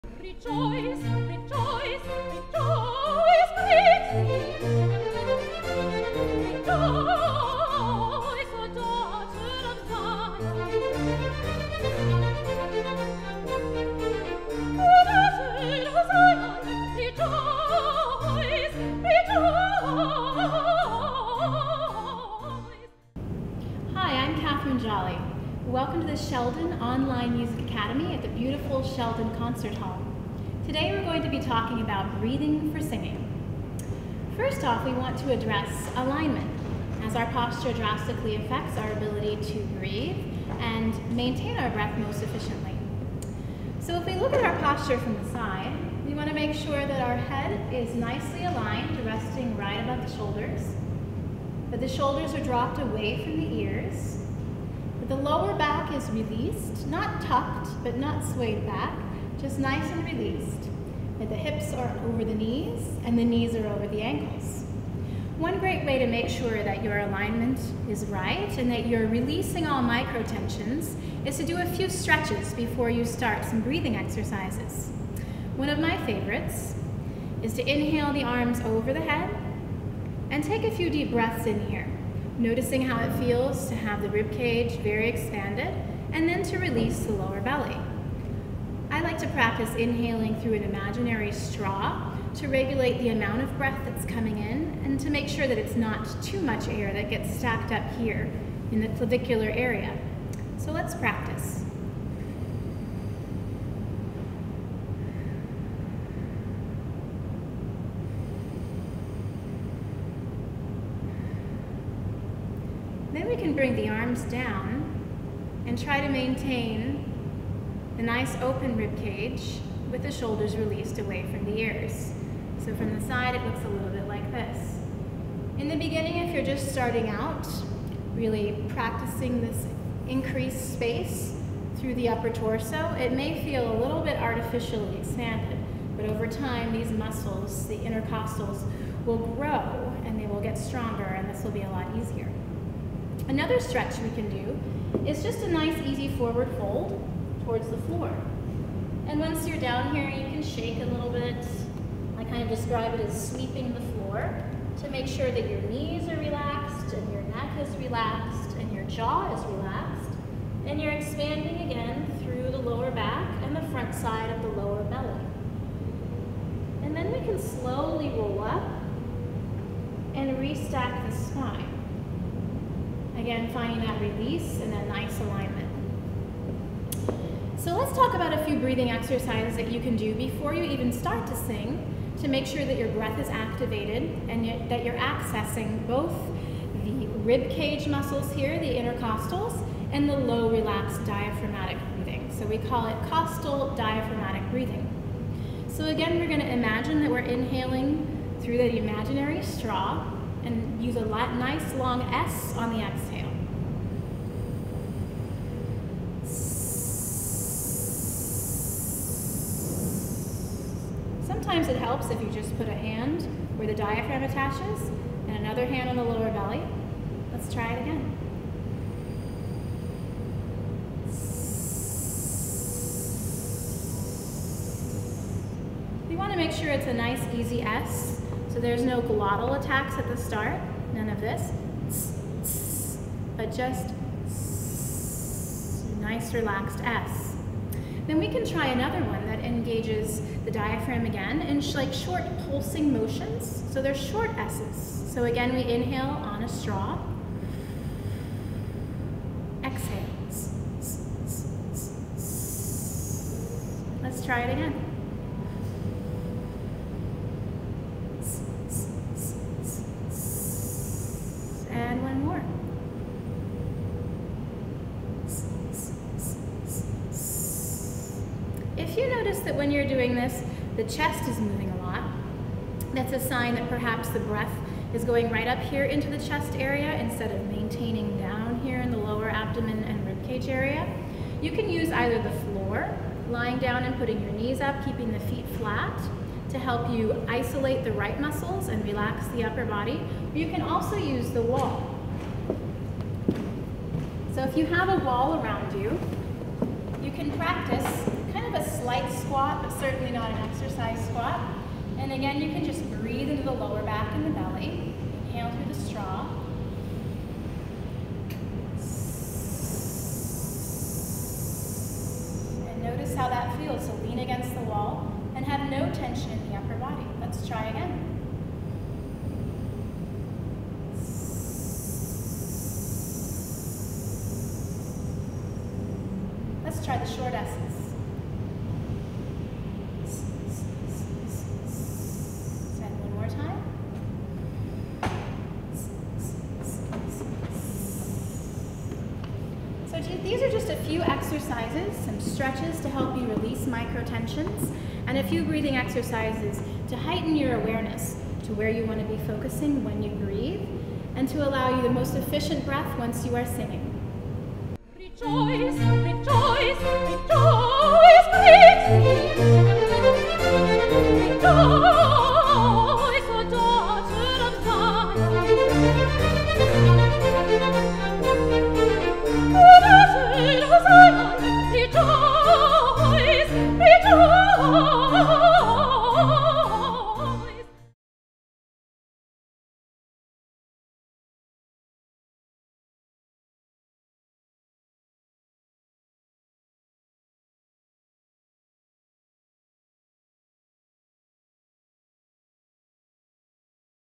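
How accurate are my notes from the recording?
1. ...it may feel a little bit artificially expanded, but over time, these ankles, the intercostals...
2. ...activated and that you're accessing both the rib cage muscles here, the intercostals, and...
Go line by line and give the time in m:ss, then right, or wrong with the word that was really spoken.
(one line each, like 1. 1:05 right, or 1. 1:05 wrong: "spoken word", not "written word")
1. 2:12 wrong: "muscles", not "ankles"
2. 3:03 right.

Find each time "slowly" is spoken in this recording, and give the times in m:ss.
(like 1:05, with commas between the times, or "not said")
2:47.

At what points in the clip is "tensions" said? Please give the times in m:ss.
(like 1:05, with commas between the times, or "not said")
1:10, 5:15, 5:44.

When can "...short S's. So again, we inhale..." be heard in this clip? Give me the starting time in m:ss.
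4:03.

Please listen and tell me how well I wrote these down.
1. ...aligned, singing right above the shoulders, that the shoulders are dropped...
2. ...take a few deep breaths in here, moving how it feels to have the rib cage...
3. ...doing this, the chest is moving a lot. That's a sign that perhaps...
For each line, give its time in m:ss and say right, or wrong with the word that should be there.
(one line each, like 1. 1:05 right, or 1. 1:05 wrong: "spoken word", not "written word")
1. 0:48 wrong: "resting", not "singing"
2. 1:20 wrong: "noticing", not "moving"
3. 4:29 right.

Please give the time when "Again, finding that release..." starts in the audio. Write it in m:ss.
2:53.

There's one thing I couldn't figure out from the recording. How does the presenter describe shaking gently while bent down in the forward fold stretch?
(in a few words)
sweeping the floor.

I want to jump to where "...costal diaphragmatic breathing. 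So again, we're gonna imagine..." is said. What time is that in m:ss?
3:13.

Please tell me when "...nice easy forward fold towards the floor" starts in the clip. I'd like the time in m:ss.
2:25.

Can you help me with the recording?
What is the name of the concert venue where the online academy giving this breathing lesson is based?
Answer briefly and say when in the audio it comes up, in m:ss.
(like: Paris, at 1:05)
Sheldon Concert Hall, at 0:28.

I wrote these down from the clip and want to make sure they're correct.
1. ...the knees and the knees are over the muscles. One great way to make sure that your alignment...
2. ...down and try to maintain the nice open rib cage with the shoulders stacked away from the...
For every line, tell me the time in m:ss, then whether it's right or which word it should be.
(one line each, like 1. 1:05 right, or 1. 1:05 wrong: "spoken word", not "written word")
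1. 1:02 wrong: "ankles", not "muscles"
2. 1:54 wrong: "released", not "stacked".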